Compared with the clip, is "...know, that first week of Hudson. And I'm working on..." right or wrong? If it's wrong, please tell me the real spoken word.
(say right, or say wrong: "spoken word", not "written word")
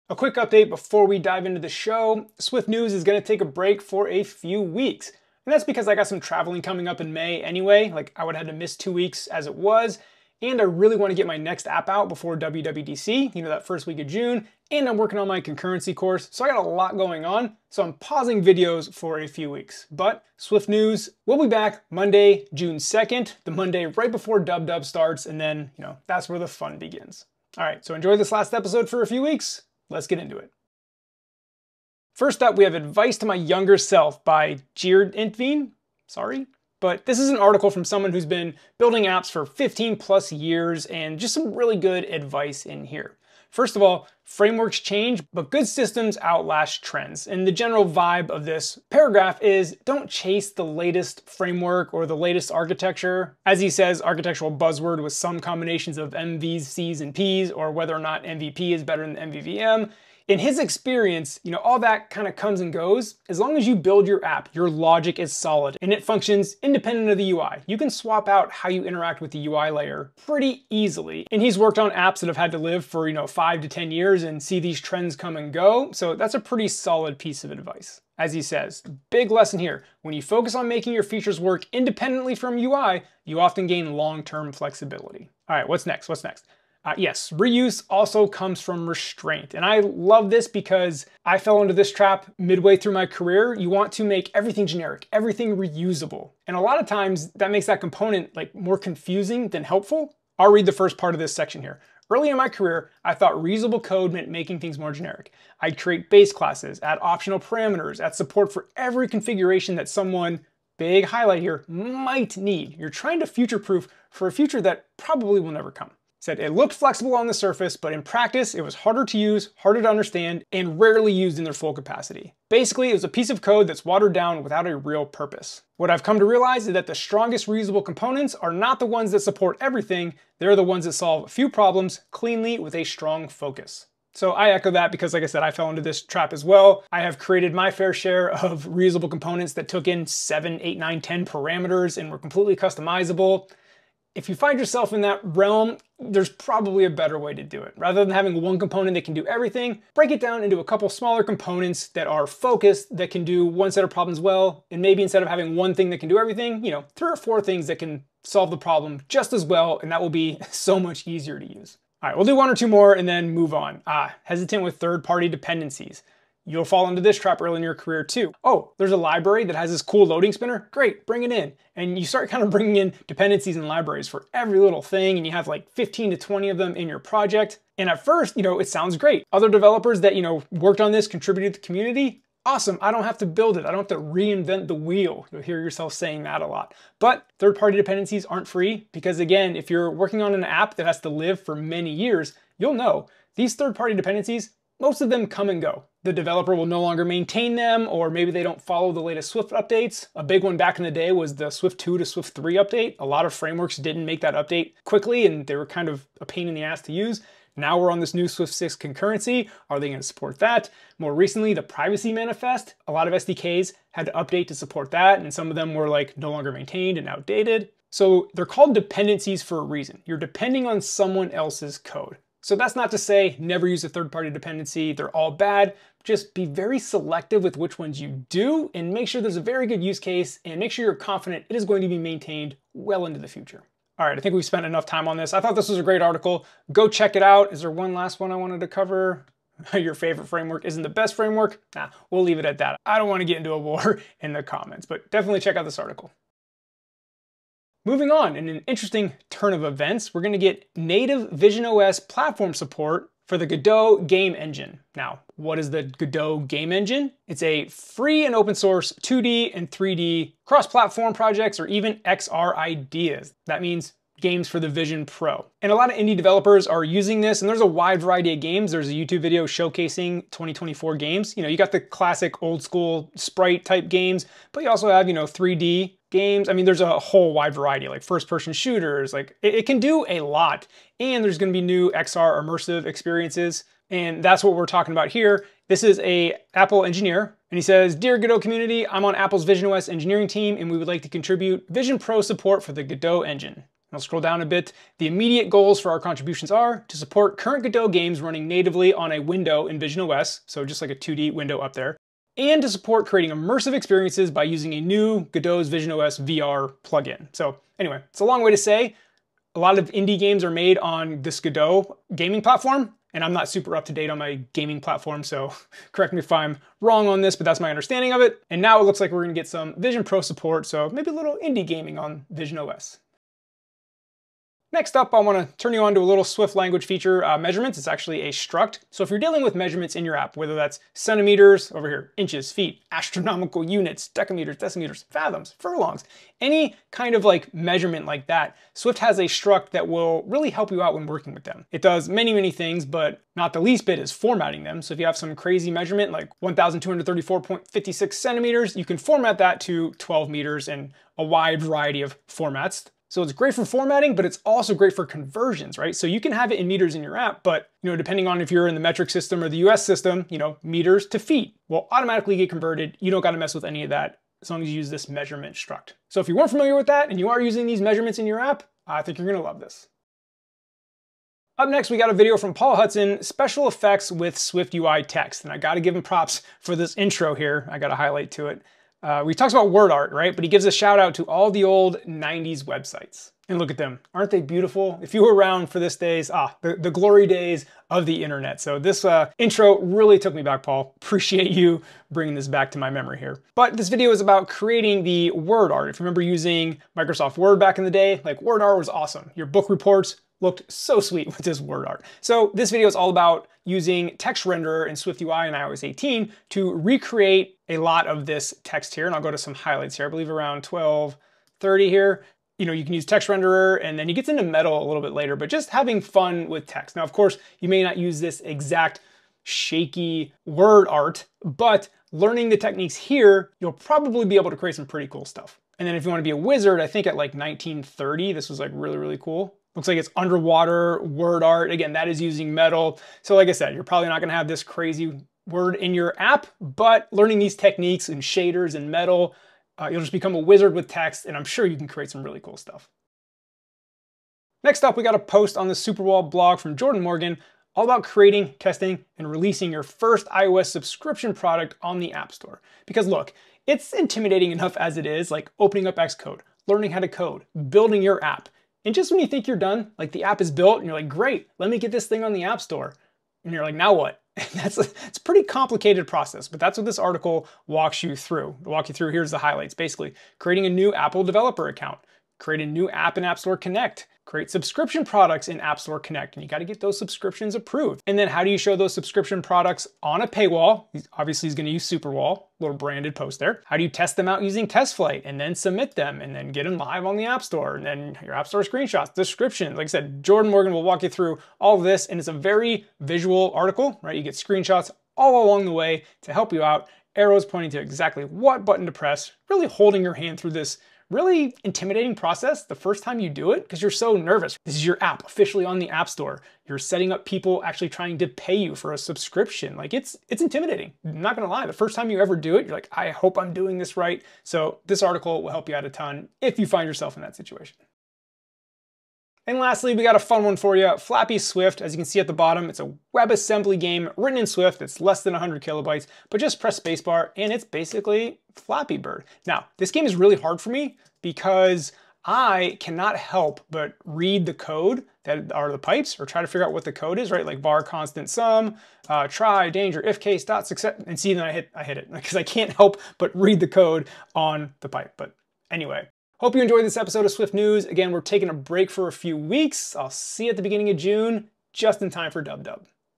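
wrong: "June", not "Hudson".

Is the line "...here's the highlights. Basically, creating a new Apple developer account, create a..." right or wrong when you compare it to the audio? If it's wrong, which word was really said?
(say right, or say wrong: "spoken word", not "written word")
right.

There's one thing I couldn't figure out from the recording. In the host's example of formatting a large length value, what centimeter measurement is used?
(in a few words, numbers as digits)
1,234.56.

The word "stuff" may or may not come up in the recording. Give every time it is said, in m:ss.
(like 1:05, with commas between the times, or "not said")
7:05, 7:22.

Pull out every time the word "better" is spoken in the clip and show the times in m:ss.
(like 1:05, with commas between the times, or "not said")
0:58, 2:26.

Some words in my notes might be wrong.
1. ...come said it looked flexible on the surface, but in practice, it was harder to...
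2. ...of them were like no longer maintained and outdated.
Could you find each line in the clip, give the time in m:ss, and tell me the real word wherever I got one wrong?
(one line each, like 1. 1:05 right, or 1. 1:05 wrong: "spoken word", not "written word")
1. 1:55 right
2. 3:35 right.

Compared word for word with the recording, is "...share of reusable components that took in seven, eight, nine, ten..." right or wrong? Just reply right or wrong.
right.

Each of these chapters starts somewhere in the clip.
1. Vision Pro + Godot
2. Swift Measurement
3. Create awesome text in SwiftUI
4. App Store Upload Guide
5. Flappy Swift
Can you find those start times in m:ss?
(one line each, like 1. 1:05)
1. 4:06
2. 5:23
3. 6:10
4. 7:23
5. 8:38.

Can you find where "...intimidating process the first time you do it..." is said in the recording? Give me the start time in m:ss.
8:21.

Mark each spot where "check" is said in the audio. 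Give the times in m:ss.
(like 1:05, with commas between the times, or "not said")
3:56, 4:05.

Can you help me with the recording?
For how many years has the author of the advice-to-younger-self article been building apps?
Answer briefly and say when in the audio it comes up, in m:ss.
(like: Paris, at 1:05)
15 plus years, at 0:39.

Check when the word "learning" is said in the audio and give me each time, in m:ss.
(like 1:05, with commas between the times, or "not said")
7:02, 7:17, 7:36.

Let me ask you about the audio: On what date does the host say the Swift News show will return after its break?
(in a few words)
Monday, June 2nd.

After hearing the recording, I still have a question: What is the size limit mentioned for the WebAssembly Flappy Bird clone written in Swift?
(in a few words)
less than 100 kilobytes.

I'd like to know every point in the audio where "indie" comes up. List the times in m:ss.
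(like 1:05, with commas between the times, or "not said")
4:25, 5:09, 5:21.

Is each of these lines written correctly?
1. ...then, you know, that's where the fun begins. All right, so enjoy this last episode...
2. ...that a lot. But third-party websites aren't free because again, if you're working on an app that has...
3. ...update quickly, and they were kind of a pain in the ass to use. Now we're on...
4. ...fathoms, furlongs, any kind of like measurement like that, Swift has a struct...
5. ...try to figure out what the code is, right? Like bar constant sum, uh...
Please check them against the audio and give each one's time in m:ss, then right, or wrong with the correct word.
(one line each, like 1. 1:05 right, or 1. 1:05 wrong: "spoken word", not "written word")
1. 0:25 right
2. 3:06 wrong: "dependencies", not "websites"
3. 3:24 right
4. 5:35 right
5. 8:56 right.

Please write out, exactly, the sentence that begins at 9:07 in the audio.
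Again, we're taking a break for a few weeks.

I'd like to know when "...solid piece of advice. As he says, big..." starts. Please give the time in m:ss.
1:16.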